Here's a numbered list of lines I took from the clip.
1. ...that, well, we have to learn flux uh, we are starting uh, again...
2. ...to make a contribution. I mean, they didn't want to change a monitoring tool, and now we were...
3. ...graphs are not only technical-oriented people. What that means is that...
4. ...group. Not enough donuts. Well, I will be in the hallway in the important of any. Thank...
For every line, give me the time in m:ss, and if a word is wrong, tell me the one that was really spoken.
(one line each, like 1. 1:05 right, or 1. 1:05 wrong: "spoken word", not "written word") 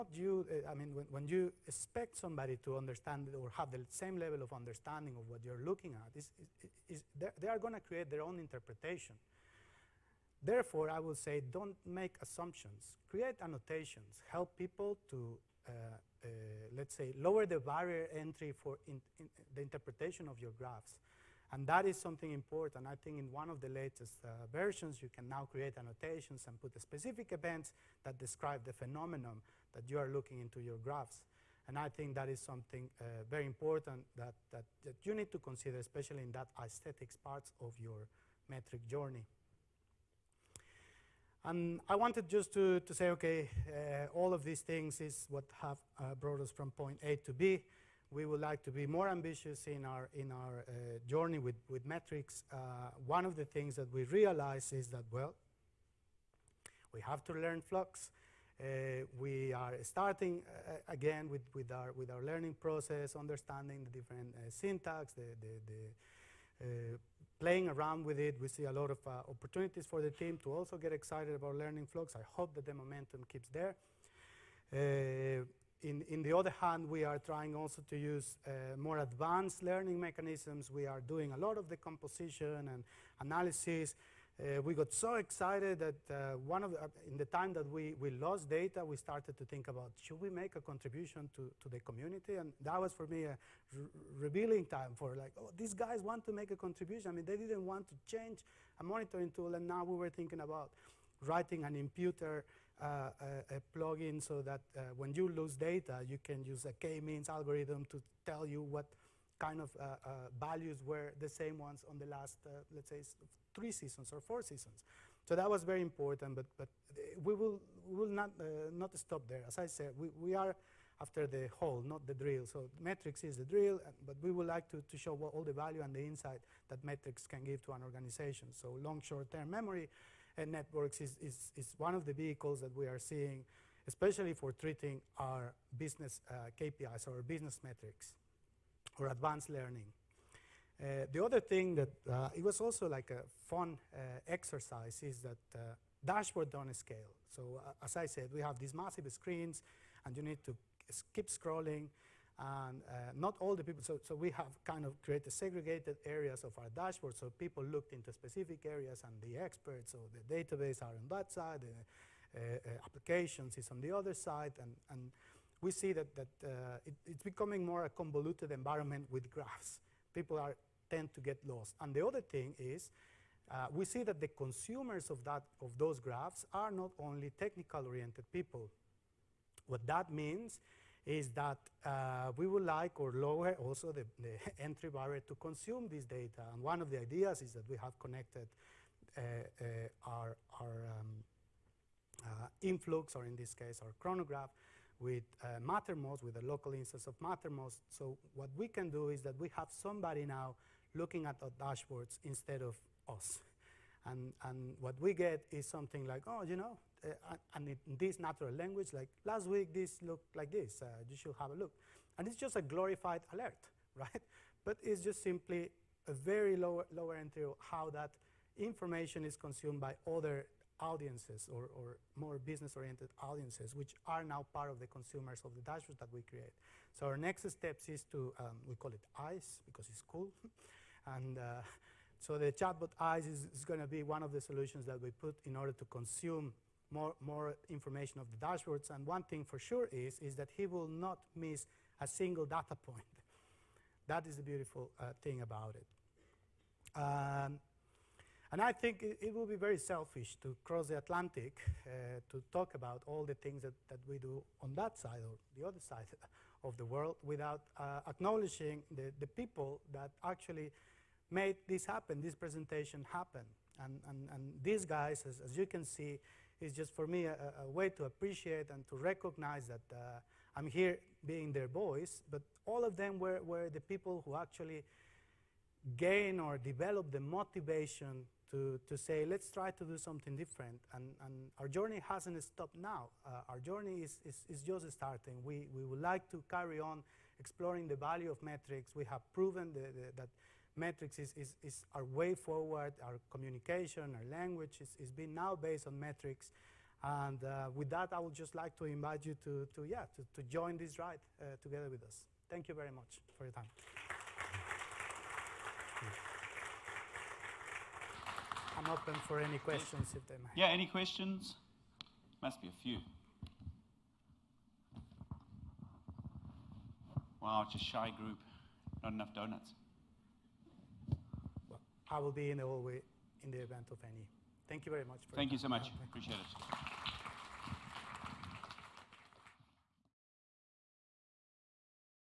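1. 0:54 right
2. 1:36 right
3. 2:55 right
4. 5:18 wrong: "event", not "important".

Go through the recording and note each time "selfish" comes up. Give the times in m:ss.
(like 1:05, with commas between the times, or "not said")
4:09.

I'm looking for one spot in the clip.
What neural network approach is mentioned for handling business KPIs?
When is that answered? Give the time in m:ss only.
2:08.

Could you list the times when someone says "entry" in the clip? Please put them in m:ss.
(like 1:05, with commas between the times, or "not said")
0:18, 3:04, 3:37.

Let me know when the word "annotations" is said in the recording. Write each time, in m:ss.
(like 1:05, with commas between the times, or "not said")
0:13, 0:25.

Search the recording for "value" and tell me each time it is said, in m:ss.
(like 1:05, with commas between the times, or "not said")
1:50, 2:05, 4:47.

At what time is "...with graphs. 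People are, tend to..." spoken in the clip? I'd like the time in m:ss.
2:49.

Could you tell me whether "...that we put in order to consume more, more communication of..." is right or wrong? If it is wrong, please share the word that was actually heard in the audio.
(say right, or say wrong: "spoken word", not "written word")
wrong: "information", not "communication".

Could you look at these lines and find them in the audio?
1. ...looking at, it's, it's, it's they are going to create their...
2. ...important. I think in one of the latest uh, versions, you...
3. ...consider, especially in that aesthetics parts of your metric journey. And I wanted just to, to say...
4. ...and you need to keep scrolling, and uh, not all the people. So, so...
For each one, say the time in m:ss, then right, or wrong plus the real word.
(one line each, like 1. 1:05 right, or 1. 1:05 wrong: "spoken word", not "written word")
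1. 0:05 right
2. 0:22 right
3. 0:35 right
4. 2:30 right.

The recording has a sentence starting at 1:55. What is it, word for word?
So that was very important, but, but eh, we will, will not, not stop there.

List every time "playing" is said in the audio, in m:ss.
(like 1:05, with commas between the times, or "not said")
1:07.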